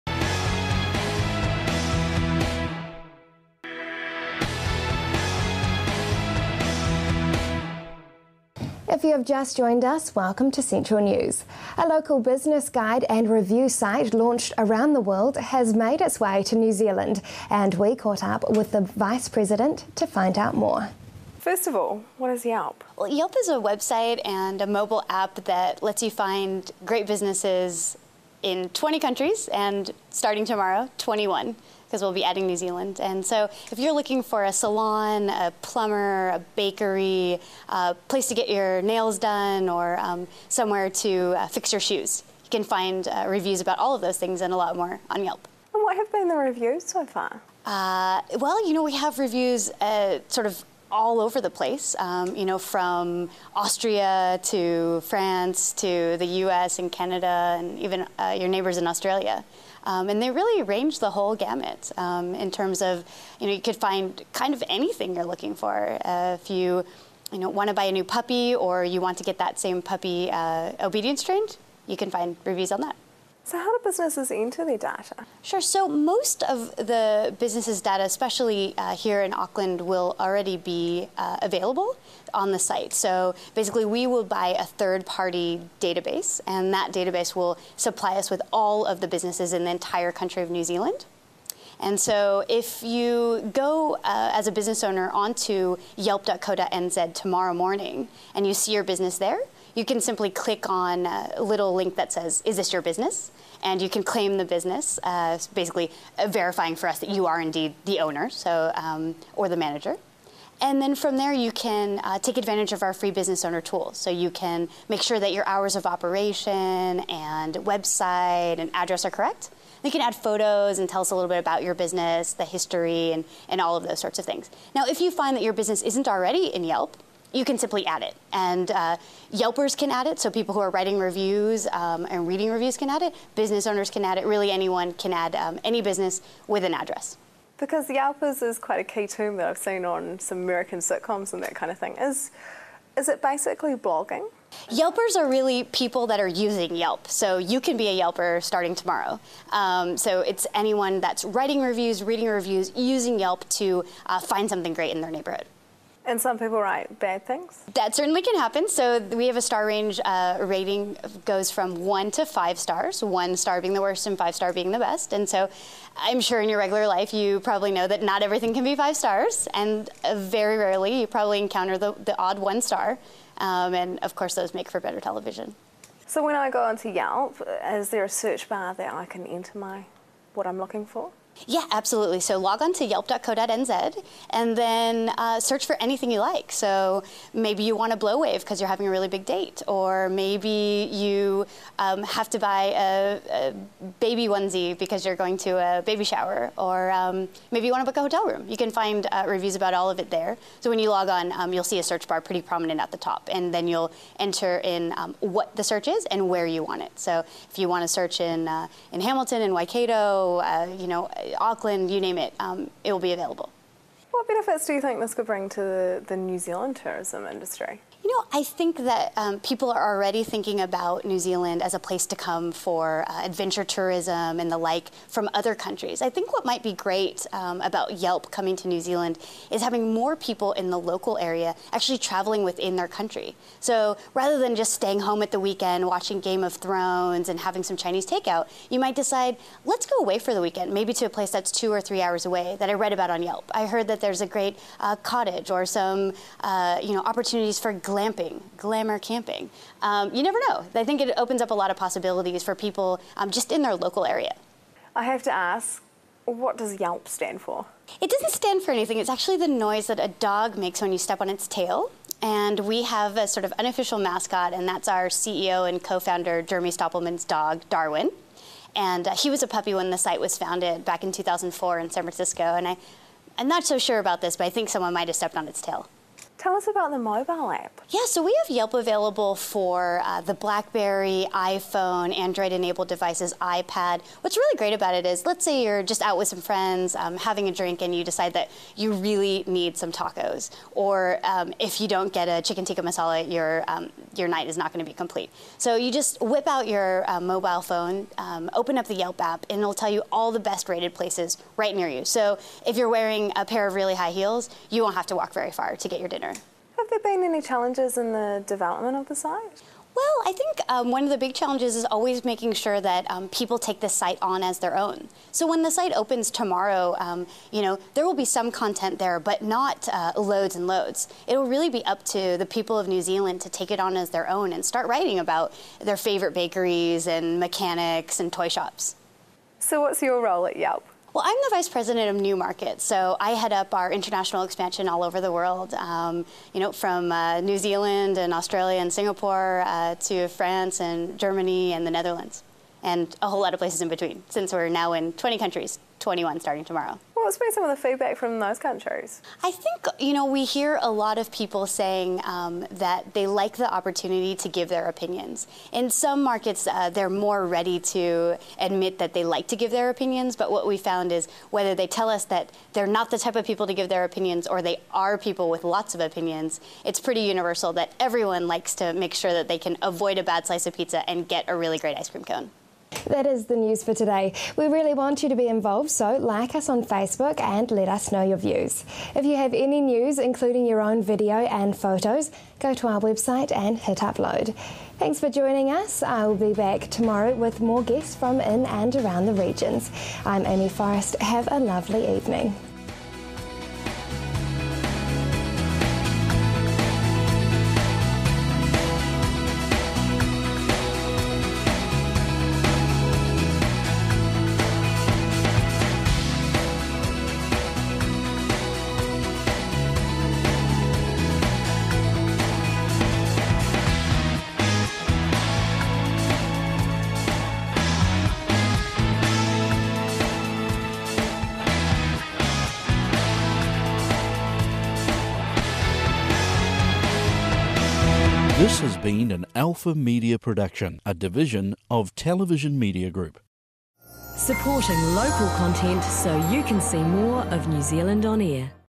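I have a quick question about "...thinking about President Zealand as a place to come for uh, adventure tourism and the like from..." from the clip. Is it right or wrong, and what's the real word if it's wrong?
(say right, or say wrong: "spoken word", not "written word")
wrong: "New", not "President".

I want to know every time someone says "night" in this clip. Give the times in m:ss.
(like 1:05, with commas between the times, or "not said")
4:54.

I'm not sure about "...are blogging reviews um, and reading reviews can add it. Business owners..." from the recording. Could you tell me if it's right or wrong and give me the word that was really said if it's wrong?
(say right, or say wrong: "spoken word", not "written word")
wrong: "writing", not "blogging".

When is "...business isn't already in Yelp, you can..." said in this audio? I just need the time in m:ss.
2:05.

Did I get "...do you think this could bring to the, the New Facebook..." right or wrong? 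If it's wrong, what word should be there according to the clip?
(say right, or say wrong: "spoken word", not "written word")
wrong: "Zealand", not "Facebook".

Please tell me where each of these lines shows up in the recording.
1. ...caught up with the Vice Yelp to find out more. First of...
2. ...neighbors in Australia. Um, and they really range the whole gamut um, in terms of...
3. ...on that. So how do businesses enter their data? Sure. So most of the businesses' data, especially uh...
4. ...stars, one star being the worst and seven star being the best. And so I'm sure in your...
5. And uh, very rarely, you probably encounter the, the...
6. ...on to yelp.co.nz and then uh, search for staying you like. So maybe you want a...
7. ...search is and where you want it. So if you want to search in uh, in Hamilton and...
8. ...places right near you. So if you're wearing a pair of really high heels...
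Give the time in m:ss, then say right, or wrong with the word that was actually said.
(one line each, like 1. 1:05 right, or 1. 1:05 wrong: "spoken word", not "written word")
1. 0:17 wrong: "President", not "Yelp"
2. 0:58 right
3. 1:12 right
4. 2:42 wrong: "five", not "seven"
5. 2:49 right
6. 3:02 wrong: "anything", not "staying"
7. 3:25 right
8. 5:00 right.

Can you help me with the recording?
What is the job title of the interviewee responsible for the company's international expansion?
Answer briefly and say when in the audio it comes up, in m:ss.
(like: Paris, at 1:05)
Vice President of New Market, at 5:31.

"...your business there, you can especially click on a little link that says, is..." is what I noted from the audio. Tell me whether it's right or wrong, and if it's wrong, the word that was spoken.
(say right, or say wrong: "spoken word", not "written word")
wrong: "simply", not "especially".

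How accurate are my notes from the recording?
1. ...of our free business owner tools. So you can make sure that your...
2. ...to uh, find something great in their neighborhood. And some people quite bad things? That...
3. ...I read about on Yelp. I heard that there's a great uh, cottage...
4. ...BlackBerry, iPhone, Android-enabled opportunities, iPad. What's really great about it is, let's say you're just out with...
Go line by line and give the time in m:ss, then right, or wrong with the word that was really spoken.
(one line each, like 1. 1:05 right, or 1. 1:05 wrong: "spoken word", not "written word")
1. 1:52 right
2. 2:33 wrong: "write", not "quite"
3. 4:02 right
4. 4:40 wrong: "devices", not "opportunities".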